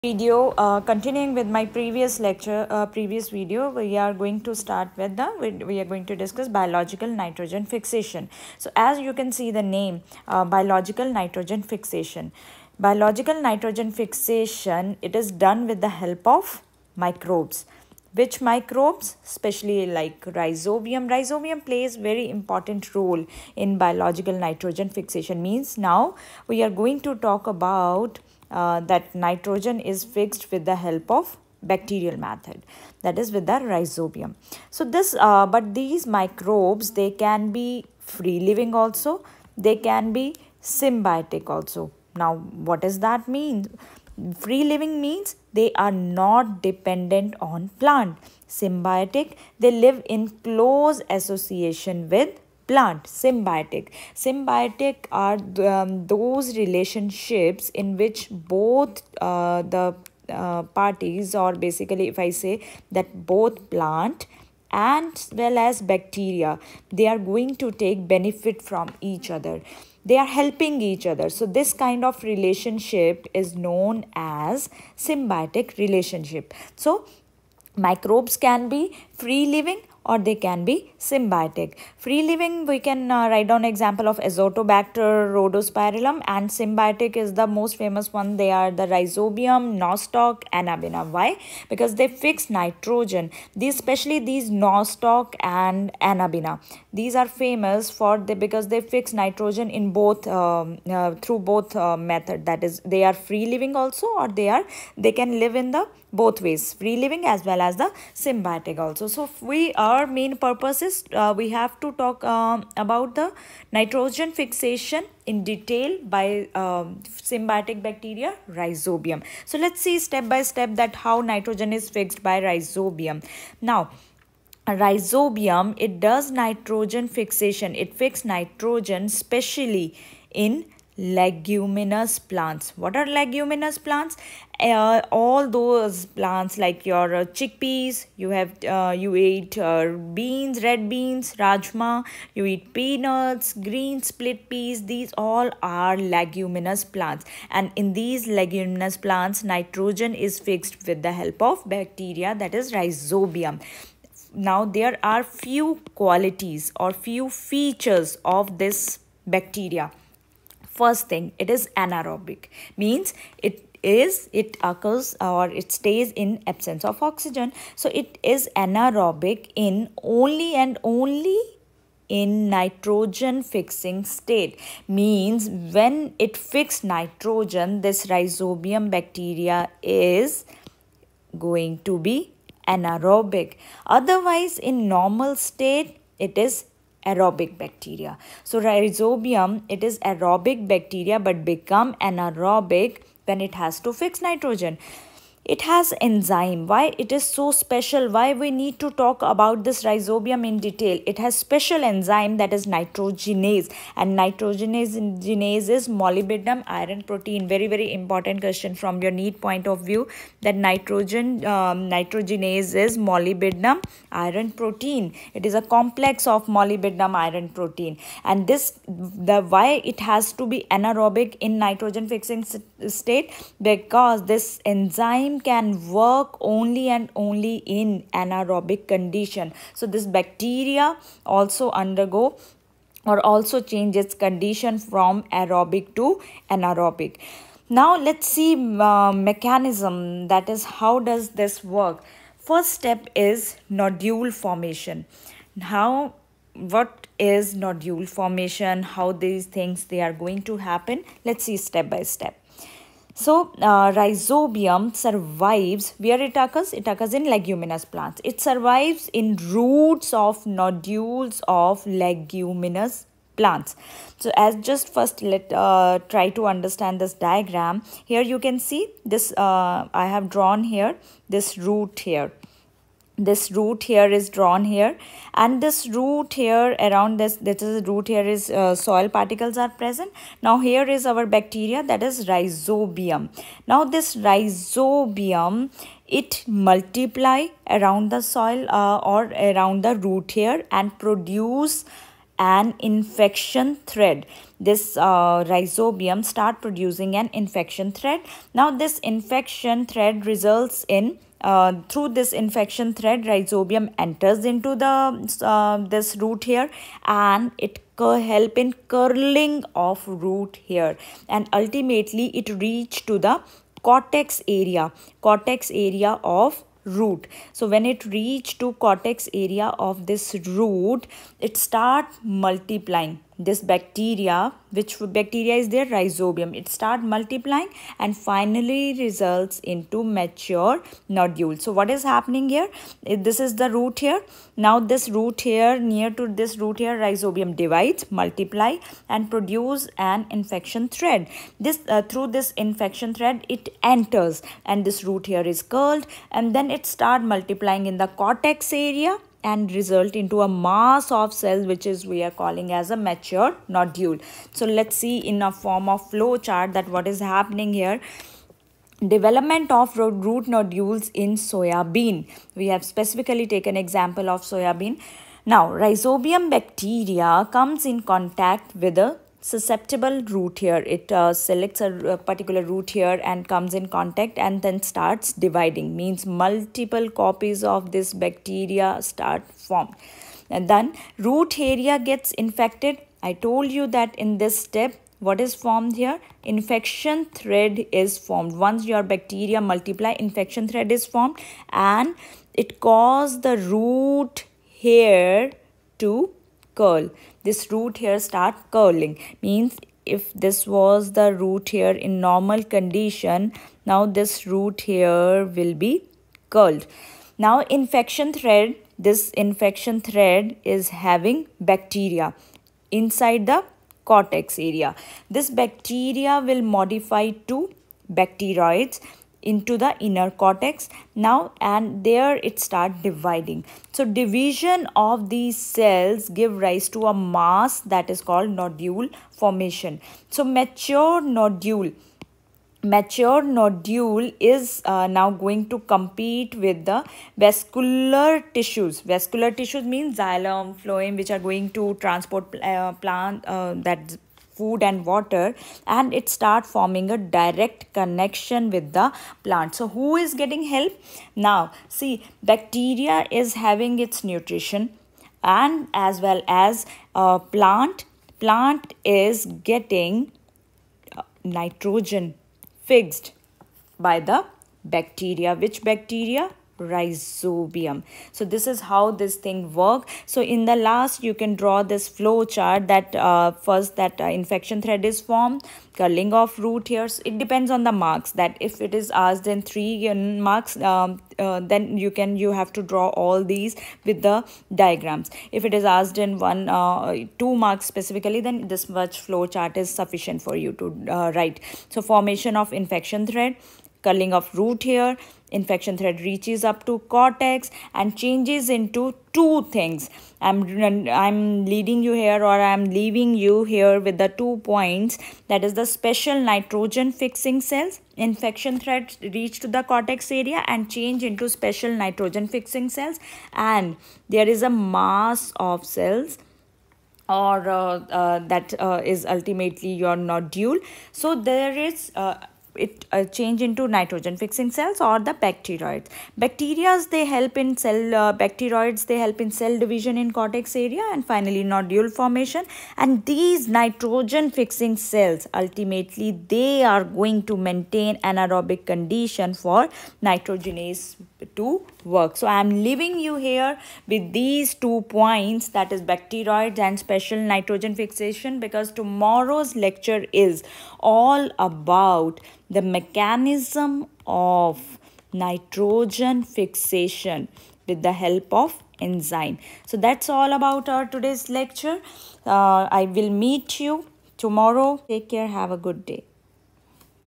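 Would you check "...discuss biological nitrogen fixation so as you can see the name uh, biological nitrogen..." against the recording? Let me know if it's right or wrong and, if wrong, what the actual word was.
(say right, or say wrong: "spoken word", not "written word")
right.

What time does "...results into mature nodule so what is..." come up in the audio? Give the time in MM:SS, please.
05:28.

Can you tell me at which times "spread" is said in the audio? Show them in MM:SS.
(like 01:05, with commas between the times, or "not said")
not said.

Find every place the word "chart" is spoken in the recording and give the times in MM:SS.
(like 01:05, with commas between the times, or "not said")
05:56, 07:52, 08:09.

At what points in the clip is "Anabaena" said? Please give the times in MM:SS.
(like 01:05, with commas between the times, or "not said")
01:30, 01:36.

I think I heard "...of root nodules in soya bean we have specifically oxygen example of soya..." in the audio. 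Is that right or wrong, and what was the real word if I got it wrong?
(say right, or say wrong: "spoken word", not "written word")
wrong: "taken", not "oxygen".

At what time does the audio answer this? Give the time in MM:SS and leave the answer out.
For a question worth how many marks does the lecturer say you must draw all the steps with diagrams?
07:59.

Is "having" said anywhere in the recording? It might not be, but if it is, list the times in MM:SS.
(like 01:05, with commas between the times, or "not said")
06:51, 07:33.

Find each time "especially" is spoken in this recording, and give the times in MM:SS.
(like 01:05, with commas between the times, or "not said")
00:19, 01:33.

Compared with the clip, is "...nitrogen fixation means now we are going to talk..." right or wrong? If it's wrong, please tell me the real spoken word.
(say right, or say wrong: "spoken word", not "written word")
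right.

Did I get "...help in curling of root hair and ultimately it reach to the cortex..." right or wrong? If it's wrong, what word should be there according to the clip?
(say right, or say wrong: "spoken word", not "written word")
right.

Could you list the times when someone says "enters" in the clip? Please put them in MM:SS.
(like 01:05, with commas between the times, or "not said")
05:03, 05:43.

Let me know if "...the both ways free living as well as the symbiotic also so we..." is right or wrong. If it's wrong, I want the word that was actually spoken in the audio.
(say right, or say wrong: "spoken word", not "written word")
right.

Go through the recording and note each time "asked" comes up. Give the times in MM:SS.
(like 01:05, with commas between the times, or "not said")
07:59, 08:05.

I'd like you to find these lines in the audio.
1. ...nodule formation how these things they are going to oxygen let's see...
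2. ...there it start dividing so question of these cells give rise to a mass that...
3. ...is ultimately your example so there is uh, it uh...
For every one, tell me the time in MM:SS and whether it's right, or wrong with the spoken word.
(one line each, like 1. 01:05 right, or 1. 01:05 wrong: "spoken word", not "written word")
1. 04:07 wrong: "happen", not "oxygen"
2. 07:02 wrong: "division", not "question"
3. 08:39 wrong: "nodule", not "example".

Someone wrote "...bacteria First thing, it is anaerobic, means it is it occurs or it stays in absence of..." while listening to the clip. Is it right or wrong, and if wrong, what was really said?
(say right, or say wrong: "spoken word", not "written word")
right.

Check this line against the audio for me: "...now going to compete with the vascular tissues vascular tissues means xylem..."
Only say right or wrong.
right.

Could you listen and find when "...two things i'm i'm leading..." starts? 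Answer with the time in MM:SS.
08:19.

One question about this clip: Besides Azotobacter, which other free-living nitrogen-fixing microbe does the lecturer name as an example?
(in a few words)
Rhodospirillum.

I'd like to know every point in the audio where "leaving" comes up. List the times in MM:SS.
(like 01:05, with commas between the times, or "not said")
08:22, 09:02.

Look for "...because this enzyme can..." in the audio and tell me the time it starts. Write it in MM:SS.
03:43.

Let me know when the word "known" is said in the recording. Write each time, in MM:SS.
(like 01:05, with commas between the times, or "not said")
01:13.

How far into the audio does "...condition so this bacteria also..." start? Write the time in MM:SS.
03:48.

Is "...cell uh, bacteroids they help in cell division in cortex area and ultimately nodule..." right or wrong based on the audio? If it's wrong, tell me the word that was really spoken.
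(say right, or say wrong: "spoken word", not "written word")
wrong: "finally", not "ultimately".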